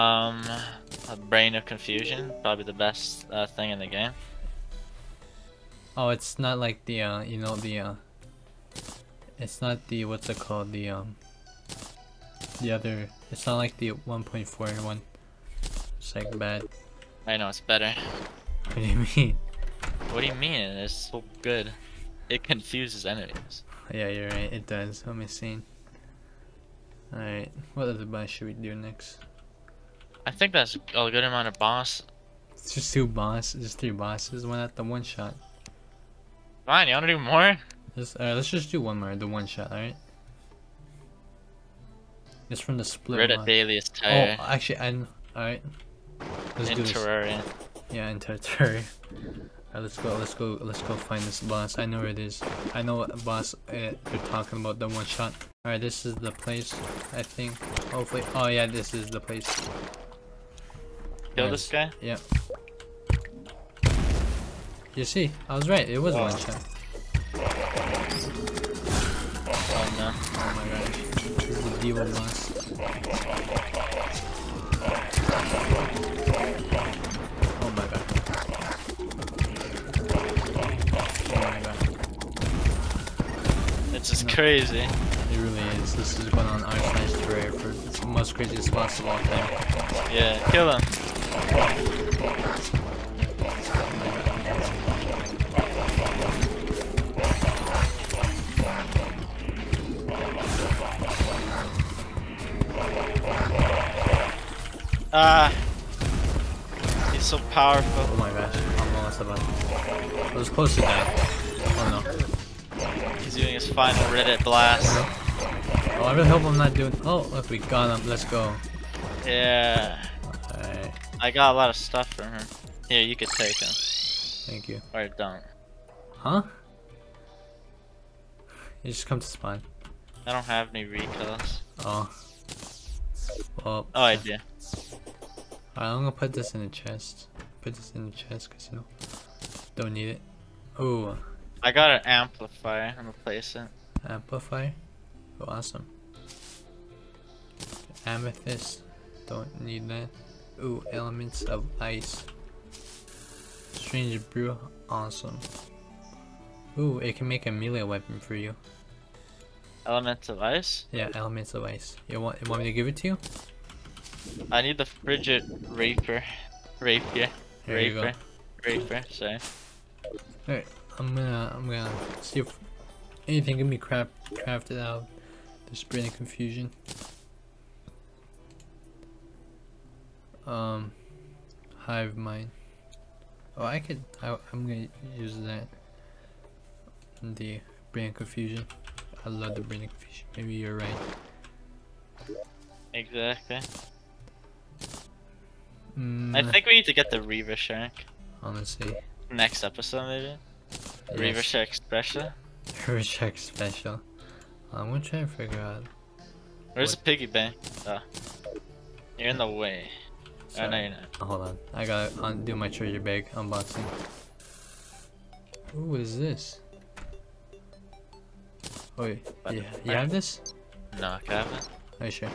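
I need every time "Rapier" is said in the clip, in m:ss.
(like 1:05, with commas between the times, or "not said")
2:46.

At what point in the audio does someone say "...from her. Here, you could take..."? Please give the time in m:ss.
2:02.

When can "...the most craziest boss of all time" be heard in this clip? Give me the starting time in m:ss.
1:27.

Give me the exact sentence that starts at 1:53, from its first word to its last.
He's doing his final Reddit blast.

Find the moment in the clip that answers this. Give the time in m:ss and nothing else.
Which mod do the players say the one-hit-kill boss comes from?
0:42.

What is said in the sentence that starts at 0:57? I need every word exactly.
Hopefully, oh, oh yeah, this is the place.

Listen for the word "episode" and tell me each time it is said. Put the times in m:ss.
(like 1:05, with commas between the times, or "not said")
3:19.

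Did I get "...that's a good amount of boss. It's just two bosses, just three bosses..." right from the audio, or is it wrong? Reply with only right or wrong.
right.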